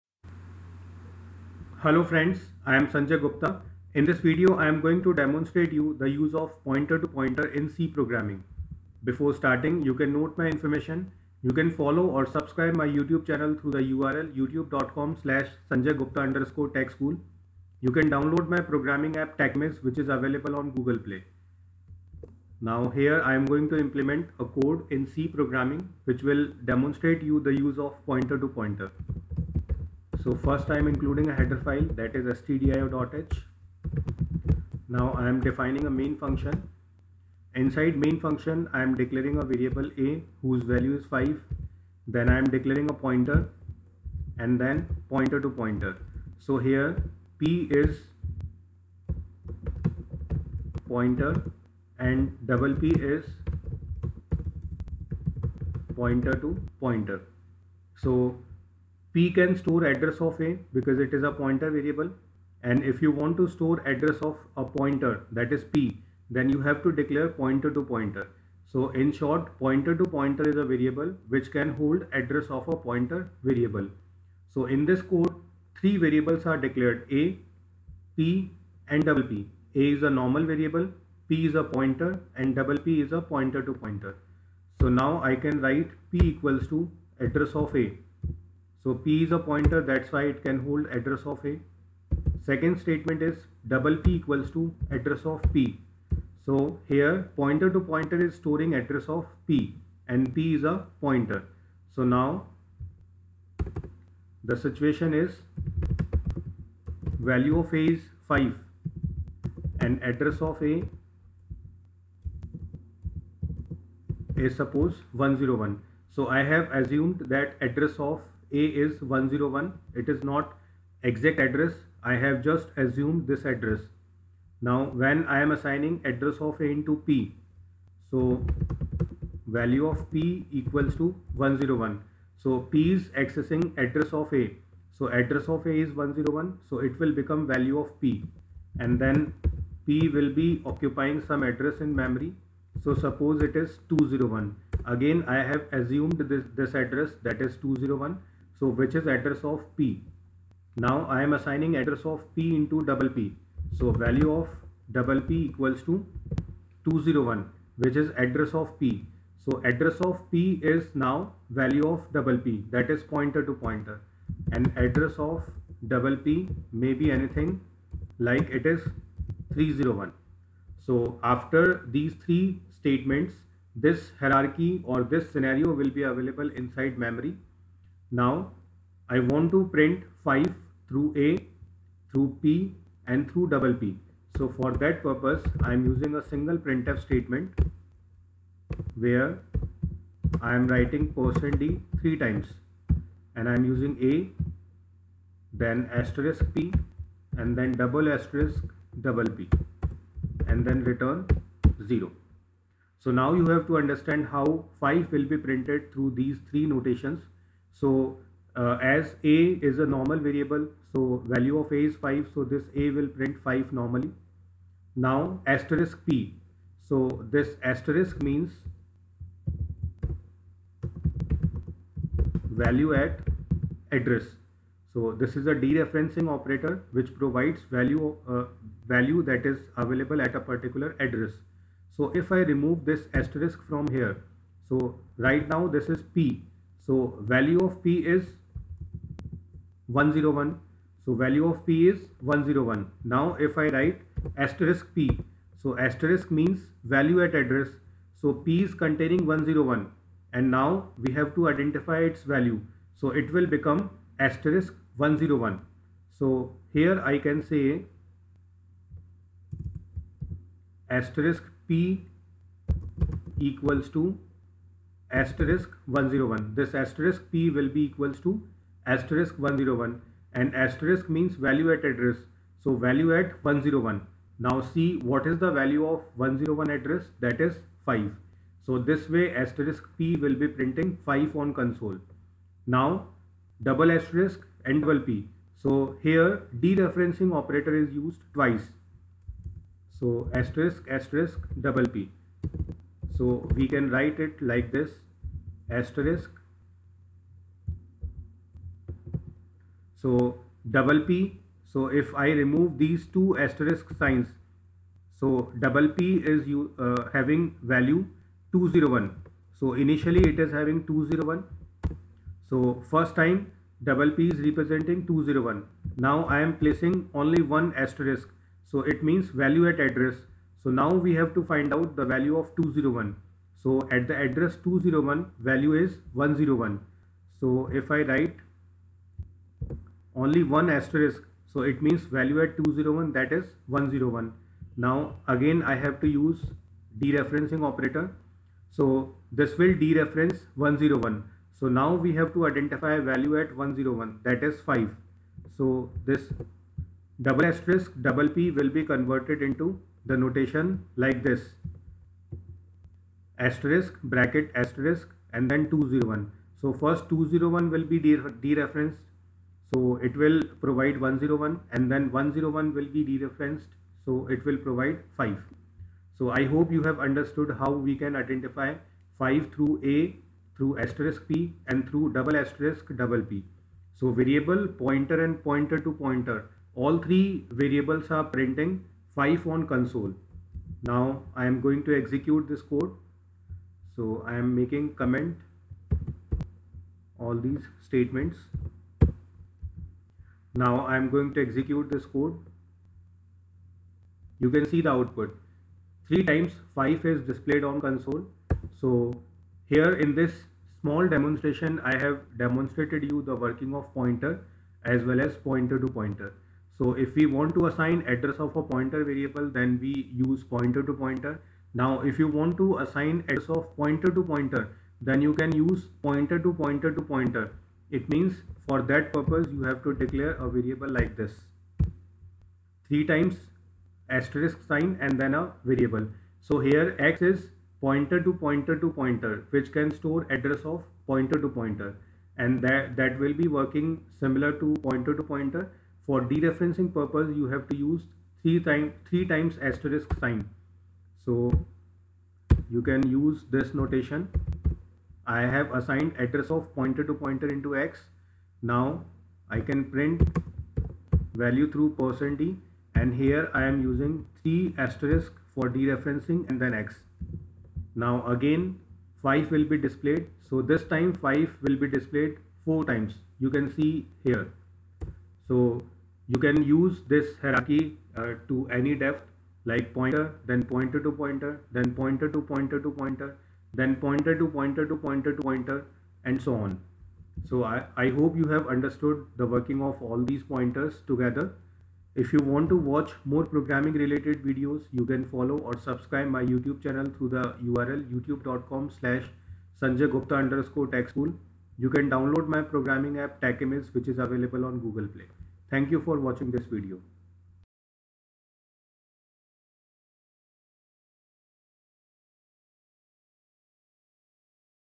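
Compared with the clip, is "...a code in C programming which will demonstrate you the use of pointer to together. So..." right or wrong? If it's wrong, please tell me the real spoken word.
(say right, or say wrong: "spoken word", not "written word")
wrong: "pointer", not "together".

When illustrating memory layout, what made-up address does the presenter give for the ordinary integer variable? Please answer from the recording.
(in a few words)
101.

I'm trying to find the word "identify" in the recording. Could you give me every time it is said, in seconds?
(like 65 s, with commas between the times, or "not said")
251 s, 342 s, 368 s.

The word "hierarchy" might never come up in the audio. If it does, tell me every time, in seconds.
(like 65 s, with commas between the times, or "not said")
174 s, 467 s.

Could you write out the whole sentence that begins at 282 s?
Now double asterisk and double P.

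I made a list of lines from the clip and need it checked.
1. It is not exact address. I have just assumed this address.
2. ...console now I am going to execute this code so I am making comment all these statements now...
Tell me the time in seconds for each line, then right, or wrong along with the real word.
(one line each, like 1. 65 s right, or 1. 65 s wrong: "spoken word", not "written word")
1. 119 s right
2. 379 s right.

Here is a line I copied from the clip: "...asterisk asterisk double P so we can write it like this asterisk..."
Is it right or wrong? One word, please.
right.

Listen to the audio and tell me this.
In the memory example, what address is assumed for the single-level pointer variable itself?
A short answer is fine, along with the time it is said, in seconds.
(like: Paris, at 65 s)
201, at 142 s.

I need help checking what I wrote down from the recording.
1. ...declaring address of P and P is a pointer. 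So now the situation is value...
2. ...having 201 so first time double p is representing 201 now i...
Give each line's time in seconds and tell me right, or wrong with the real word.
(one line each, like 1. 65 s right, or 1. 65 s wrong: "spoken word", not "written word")
1. 98 s wrong: "storing", not "declaring"
2. 310 s right.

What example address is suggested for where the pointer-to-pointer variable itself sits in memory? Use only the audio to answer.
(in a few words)
301.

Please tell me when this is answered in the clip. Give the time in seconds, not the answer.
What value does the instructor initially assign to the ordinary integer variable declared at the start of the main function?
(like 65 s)
40 s.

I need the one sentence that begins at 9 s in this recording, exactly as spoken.
Before starting, you can note my information.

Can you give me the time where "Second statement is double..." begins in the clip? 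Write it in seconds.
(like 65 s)
92 s.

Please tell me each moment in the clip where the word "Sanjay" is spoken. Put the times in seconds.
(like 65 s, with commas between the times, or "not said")
2 s, 15 s, 489 s.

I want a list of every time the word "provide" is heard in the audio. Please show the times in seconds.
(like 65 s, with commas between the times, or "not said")
227 s, 360 s, 364 s.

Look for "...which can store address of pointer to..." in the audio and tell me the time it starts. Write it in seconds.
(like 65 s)
429 s.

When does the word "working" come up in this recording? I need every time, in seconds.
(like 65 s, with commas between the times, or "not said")
403 s, 433 s, 479 s.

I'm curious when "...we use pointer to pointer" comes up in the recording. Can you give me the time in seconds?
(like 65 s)
409 s.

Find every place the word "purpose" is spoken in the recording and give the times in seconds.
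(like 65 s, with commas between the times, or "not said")
185 s, 419 s, 436 s.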